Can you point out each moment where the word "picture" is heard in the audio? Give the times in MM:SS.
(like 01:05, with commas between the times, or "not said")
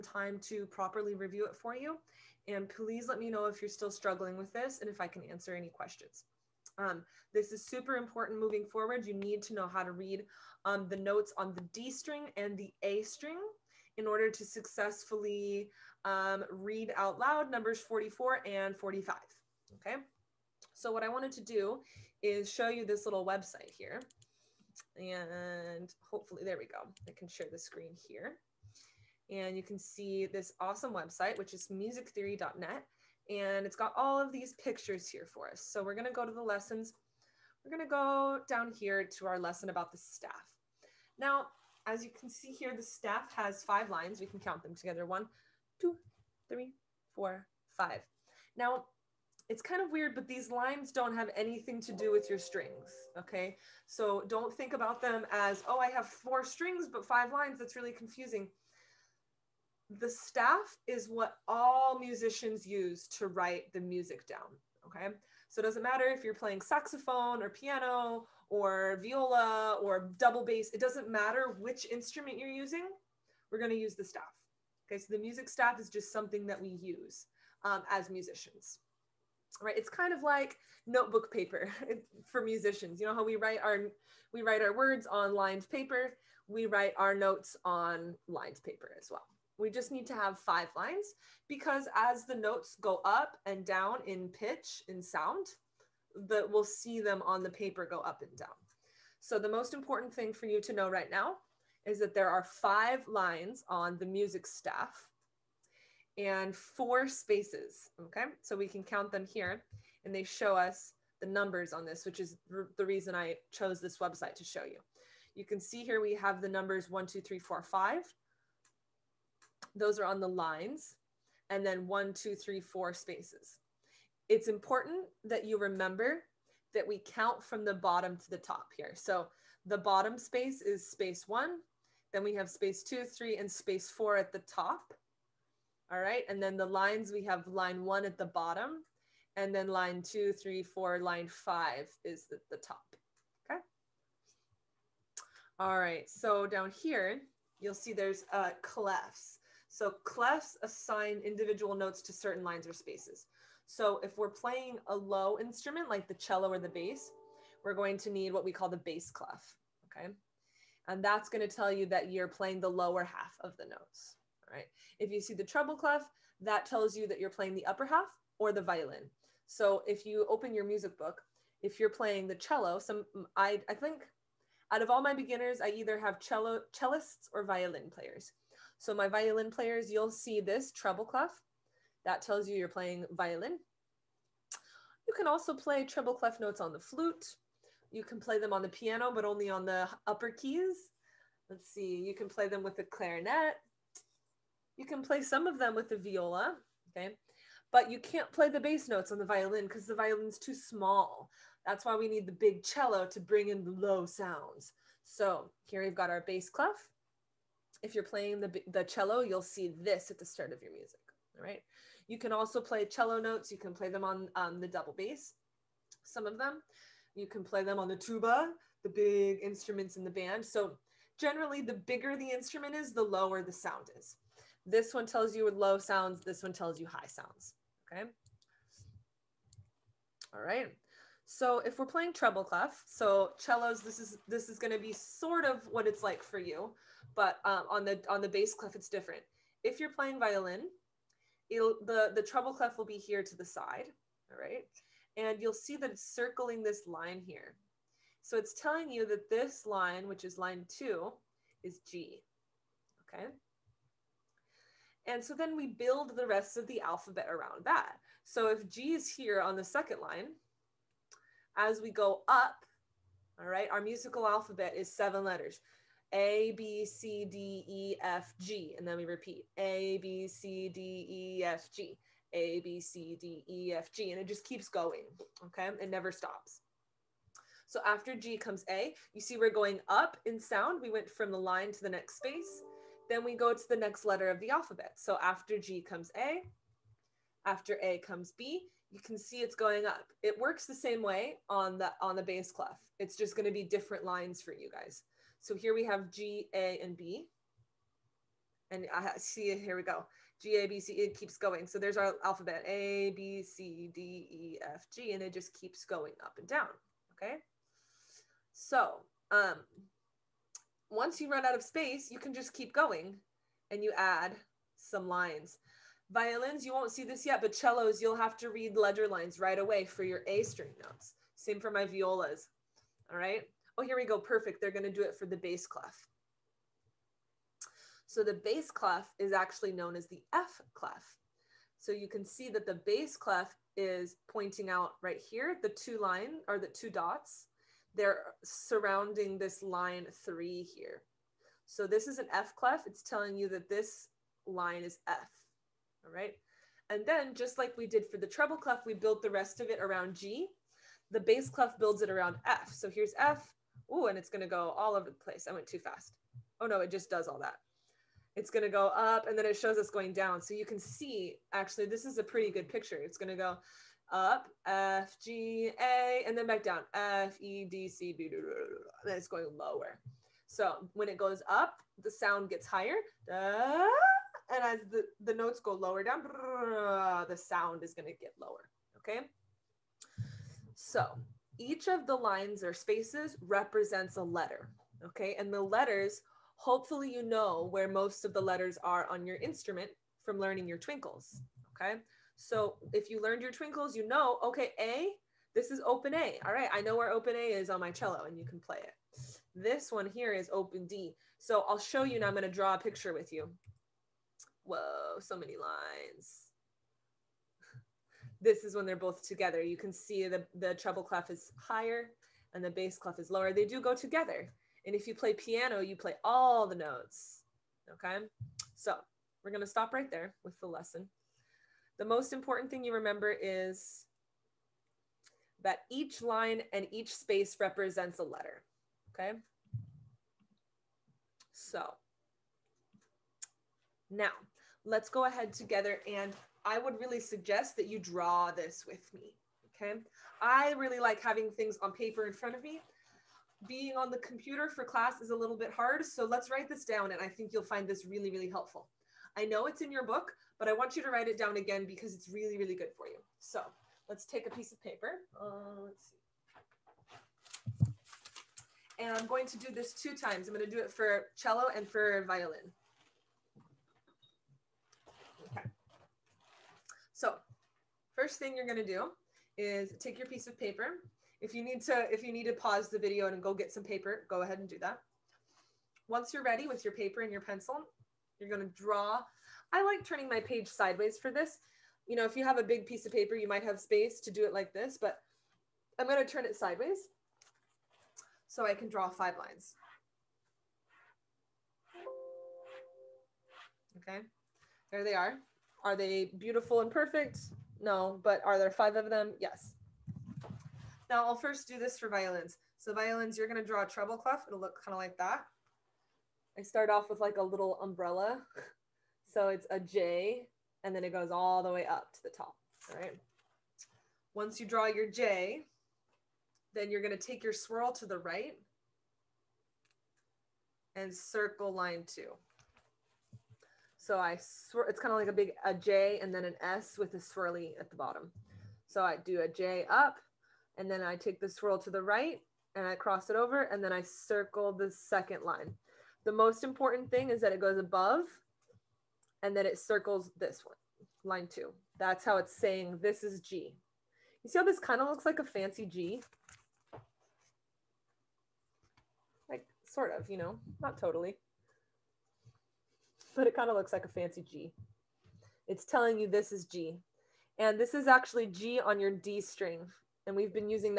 00:34, 06:02, 06:42.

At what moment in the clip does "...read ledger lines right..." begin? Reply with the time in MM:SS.
05:18.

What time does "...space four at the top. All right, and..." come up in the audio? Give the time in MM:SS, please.
02:13.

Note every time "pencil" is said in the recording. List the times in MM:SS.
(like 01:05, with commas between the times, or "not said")
07:57.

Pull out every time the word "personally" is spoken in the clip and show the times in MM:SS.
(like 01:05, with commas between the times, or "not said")
not said.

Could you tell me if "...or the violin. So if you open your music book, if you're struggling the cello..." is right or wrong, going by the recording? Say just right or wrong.
wrong.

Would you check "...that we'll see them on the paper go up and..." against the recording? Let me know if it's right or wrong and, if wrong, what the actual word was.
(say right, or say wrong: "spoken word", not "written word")
right.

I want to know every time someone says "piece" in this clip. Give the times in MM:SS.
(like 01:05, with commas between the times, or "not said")
07:34, 07:50, 08:02.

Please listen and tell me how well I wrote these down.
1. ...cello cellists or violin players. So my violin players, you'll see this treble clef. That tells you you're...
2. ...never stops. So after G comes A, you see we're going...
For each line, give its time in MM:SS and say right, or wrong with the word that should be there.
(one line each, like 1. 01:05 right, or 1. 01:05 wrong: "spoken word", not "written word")
1. 02:56 right
2. 04:35 right.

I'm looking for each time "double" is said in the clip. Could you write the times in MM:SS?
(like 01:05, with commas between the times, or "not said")
01:10, 03:34.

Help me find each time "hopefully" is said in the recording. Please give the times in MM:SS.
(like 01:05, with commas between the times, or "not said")
00:26, 06:26.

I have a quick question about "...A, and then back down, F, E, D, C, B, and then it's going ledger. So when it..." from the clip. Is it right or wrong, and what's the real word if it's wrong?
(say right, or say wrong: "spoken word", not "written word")
wrong: "lower", not "ledger".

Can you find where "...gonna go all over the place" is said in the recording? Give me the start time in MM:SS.
05:54.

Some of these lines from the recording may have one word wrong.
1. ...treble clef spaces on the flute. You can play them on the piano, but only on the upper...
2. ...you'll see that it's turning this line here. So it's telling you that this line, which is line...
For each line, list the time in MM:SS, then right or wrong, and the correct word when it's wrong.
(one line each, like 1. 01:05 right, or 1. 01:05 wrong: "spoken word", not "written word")
1. 03:05 wrong: "notes", not "spaces"
2. 04:05 wrong: "circling", not "turning".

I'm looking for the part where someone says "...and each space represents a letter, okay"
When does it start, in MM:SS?
07:06.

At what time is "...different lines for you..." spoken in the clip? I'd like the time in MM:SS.
04:53.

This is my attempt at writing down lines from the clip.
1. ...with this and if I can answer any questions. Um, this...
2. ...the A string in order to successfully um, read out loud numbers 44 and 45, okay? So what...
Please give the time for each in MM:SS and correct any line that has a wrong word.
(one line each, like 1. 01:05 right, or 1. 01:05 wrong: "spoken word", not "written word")
1. 00:04 right
2. 00:12 right.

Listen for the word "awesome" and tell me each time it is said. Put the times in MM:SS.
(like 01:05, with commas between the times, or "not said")
00:30.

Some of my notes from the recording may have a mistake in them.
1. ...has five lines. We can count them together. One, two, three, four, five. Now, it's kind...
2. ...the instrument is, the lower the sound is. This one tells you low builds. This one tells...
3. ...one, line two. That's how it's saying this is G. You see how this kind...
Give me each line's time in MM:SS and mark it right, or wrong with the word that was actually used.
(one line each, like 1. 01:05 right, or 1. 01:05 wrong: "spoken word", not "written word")
1. 00:43 right
2. 03:42 wrong: "sounds", not "builds"
3. 09:00 right.